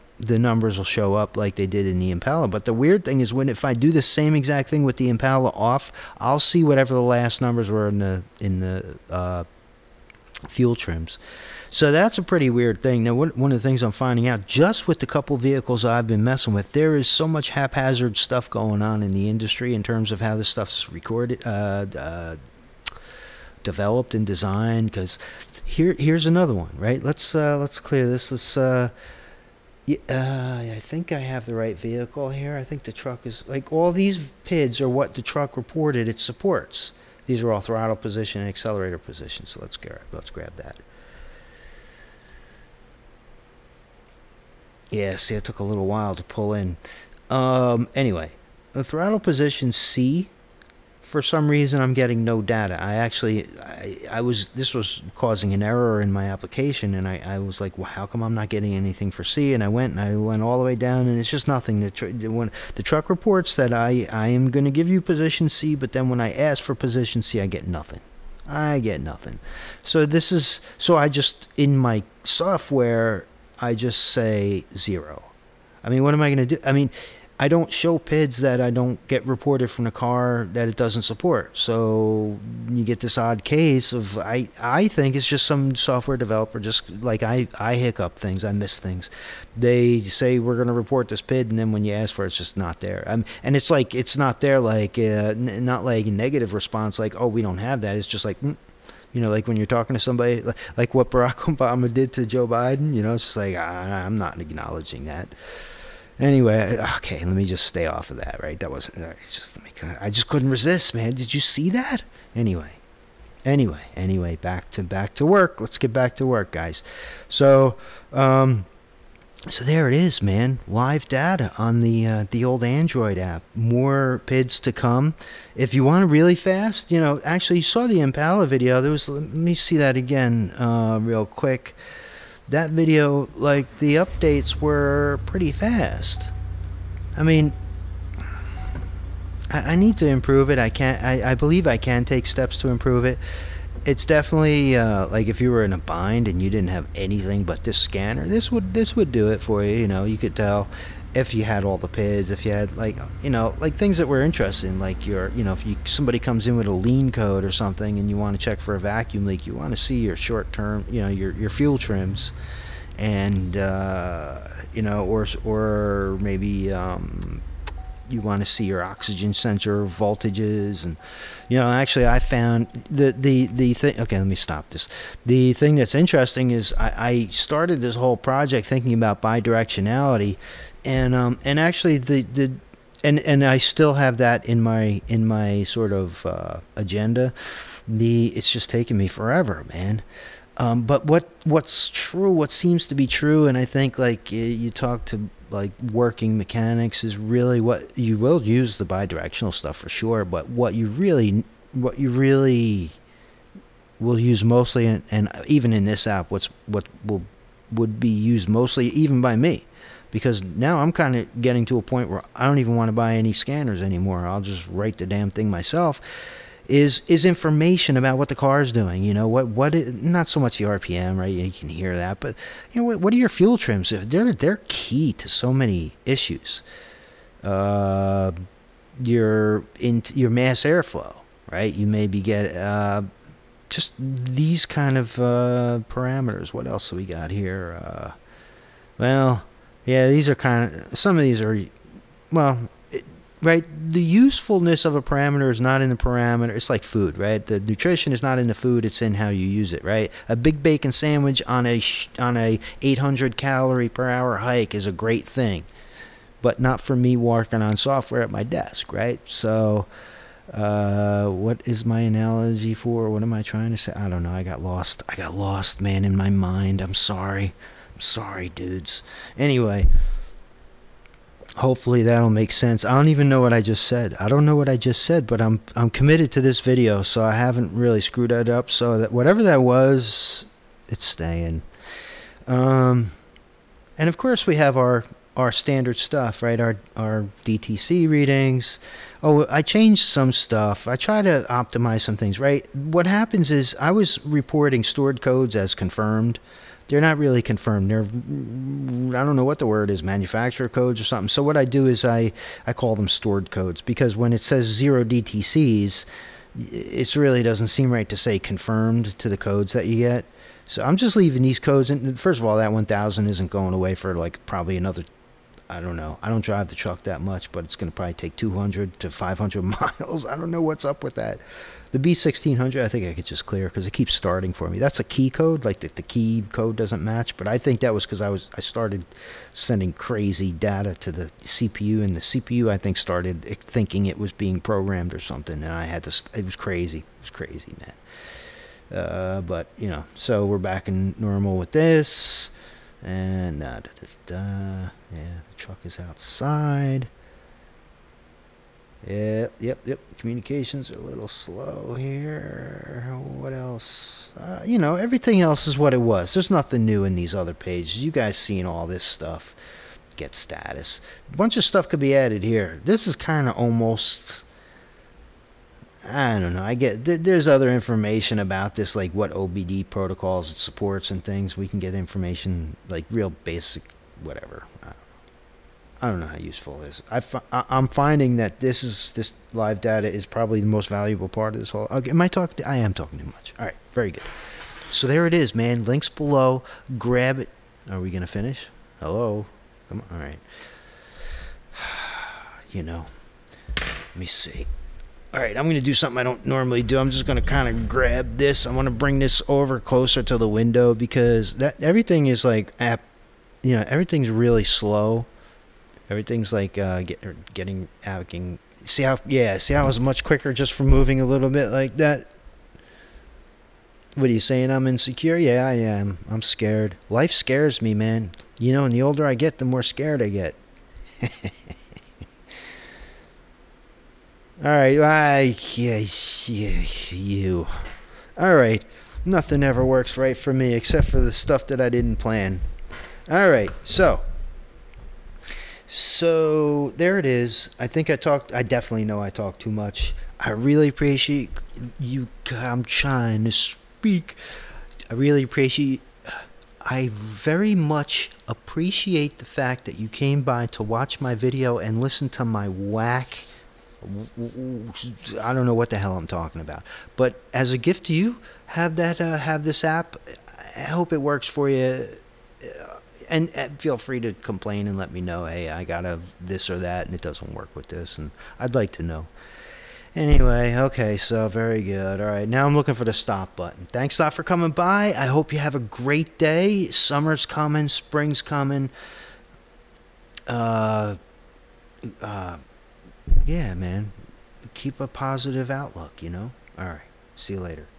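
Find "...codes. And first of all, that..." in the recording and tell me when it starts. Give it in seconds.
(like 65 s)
311 s.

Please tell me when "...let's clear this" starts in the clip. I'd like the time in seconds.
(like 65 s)
27 s.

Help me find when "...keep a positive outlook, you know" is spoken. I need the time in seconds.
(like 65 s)
484 s.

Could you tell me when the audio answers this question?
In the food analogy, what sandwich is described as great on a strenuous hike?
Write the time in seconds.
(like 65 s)
250 s.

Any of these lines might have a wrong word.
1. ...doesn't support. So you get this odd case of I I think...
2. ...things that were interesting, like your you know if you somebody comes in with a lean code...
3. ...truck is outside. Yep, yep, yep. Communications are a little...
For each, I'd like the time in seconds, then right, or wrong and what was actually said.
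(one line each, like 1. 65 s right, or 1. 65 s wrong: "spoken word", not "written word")
1. 80 s right
2. 153 s right
3. 345 s right.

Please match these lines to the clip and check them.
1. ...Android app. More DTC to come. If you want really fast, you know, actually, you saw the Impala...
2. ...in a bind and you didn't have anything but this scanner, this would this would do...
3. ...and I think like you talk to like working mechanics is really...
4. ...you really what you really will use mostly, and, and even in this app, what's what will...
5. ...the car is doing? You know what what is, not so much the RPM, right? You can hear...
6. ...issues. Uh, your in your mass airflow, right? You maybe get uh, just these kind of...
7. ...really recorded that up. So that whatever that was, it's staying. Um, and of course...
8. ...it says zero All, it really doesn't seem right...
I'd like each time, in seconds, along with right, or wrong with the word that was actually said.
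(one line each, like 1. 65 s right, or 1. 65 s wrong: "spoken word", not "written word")
1. 122 s wrong: "PIDs", not "DTC"
2. 145 s right
3. 193 s right
4. 200 s right
5. 218 s right
6. 226 s right
7. 277 s wrong: "screwed", not "recorded"
8. 304 s wrong: "DTCs", not "All".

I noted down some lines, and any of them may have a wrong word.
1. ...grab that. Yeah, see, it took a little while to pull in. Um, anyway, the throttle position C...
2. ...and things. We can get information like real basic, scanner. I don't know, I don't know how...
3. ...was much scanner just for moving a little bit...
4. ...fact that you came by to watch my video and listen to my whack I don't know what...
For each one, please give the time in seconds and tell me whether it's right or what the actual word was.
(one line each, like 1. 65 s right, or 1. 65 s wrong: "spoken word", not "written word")
1. 40 s right
2. 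371 s wrong: "whatever", not "scanner"
3. 409 s wrong: "quicker", not "scanner"
4. 449 s right.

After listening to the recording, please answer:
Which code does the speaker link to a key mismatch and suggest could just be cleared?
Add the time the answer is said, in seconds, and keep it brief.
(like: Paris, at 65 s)
B1600, at 321 s.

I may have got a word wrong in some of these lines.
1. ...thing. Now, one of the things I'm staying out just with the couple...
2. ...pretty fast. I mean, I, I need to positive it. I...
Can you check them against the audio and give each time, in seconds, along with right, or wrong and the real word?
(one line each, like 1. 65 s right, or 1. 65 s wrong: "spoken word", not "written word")
1. 12 s wrong: "finding", not "staying"
2. 135 s wrong: "improve", not "positive".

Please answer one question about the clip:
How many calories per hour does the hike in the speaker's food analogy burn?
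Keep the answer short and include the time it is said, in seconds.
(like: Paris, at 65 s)
800, at 252 s.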